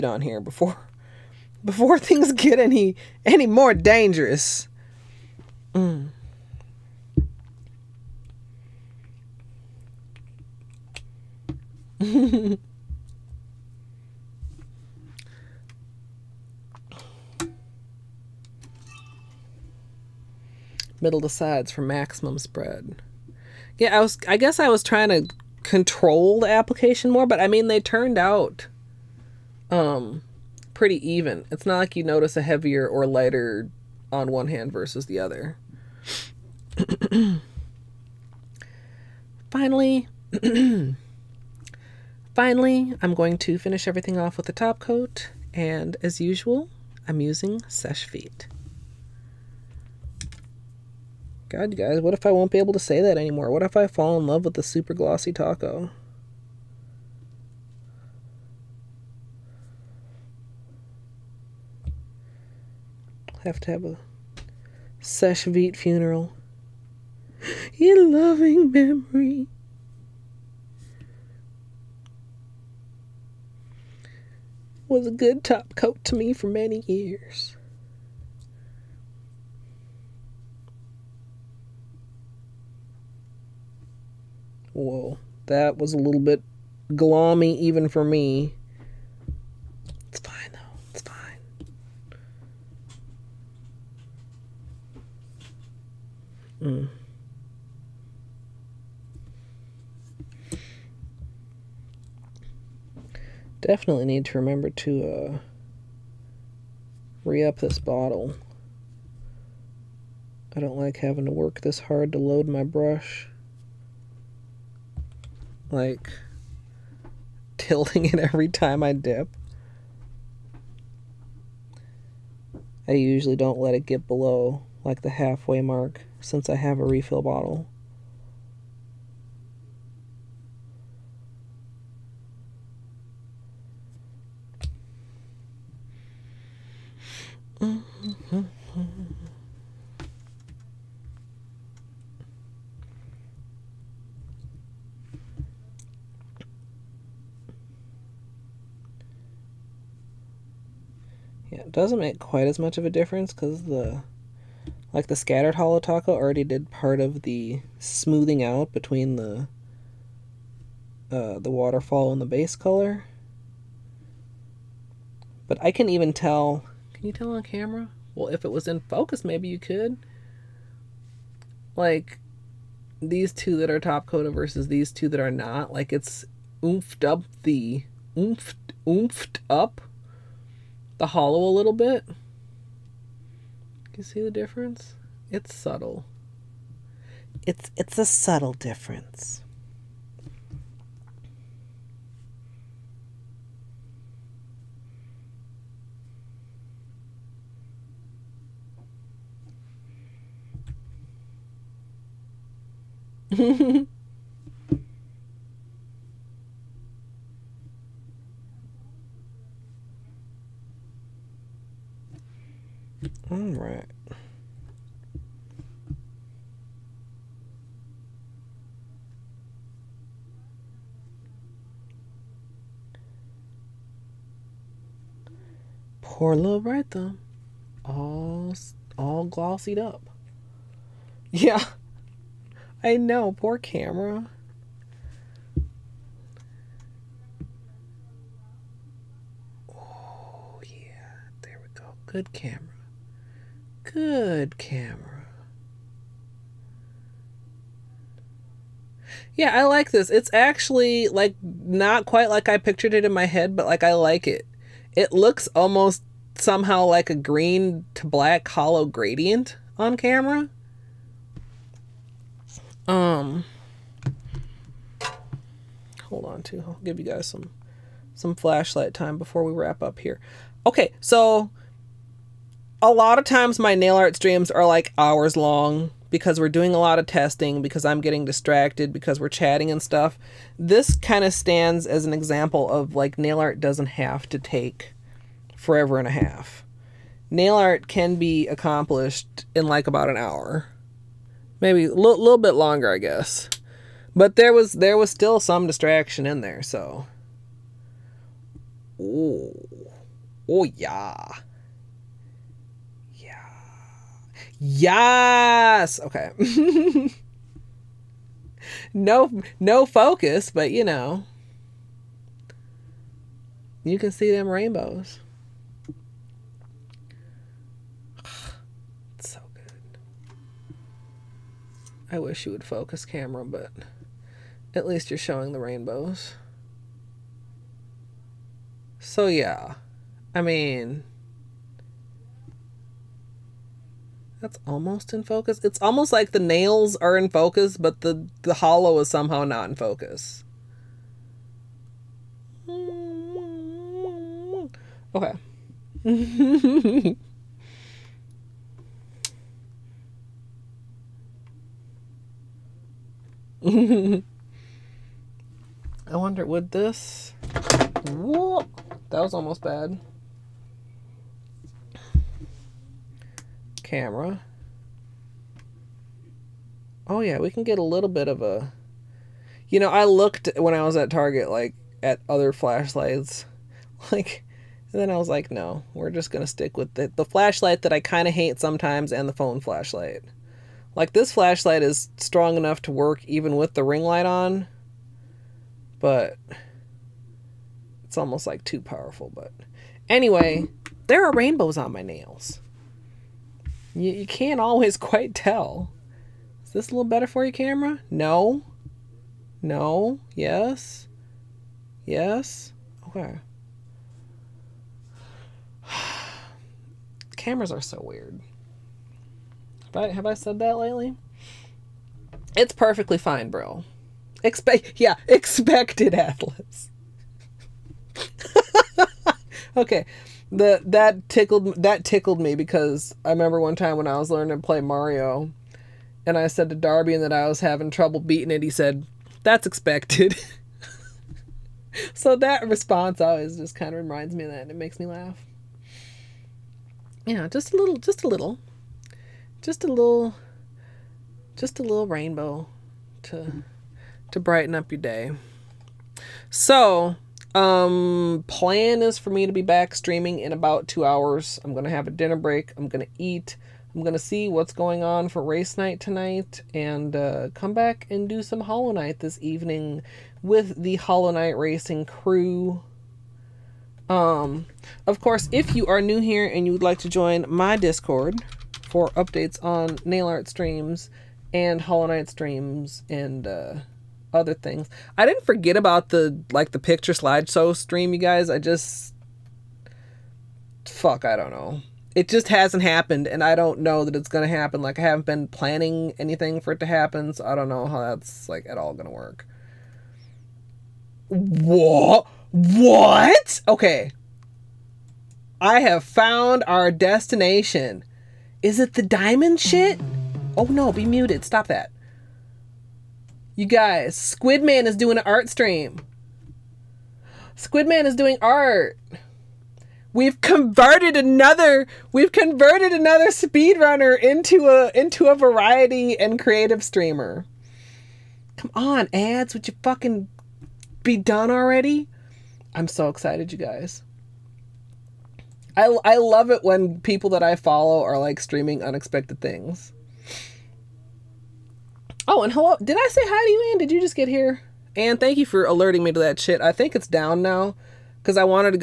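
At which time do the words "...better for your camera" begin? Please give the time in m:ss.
6:37.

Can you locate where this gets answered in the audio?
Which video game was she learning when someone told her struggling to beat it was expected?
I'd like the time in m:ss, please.
7:04.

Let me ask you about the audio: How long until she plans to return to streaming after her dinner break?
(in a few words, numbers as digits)
2 hours.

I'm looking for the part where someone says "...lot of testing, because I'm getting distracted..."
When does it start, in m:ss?
4:36.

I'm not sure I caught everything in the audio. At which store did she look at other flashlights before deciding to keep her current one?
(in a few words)
Target.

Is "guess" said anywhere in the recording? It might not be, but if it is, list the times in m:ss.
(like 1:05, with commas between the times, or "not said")
0:24, 4:52.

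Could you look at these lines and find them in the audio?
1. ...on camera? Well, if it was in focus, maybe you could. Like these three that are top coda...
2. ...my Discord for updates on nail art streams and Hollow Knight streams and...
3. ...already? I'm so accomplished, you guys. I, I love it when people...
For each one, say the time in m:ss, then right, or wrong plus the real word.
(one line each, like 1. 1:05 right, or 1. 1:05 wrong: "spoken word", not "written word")
1. 2:47 wrong: "two", not "three"
2. 7:47 right
3. 8:41 wrong: "excited", not "accomplished".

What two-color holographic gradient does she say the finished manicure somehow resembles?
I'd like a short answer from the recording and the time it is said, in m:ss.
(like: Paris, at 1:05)
green to black, at 4:17.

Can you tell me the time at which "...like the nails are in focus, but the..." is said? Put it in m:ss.
5:36.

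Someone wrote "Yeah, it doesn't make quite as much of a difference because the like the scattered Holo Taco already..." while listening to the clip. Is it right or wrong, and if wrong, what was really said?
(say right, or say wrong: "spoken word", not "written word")
right.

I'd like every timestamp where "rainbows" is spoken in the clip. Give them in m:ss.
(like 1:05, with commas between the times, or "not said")
5:14, 5:25, 6:31, 7:22.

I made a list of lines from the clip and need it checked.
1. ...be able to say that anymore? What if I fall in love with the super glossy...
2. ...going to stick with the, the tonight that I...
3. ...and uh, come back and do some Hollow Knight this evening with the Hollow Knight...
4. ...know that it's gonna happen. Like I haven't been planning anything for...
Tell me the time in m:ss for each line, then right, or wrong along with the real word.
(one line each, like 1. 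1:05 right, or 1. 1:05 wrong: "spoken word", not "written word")
1. 0:52 right
2. 6:16 wrong: "flashlight", not "tonight"
3. 7:36 right
4. 8:03 right.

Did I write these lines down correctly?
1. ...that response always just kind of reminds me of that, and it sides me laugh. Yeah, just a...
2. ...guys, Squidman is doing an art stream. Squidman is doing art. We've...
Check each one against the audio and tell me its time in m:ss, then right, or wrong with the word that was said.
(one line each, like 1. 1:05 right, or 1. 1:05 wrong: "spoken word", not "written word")
1. 7:12 wrong: "makes", not "sides"
2. 8:23 right.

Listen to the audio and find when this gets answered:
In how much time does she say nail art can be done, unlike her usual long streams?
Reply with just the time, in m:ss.
4:49.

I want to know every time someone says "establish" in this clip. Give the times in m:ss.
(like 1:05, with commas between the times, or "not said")
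not said.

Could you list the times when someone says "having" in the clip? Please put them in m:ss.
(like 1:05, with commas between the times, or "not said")
1:50, 7:07.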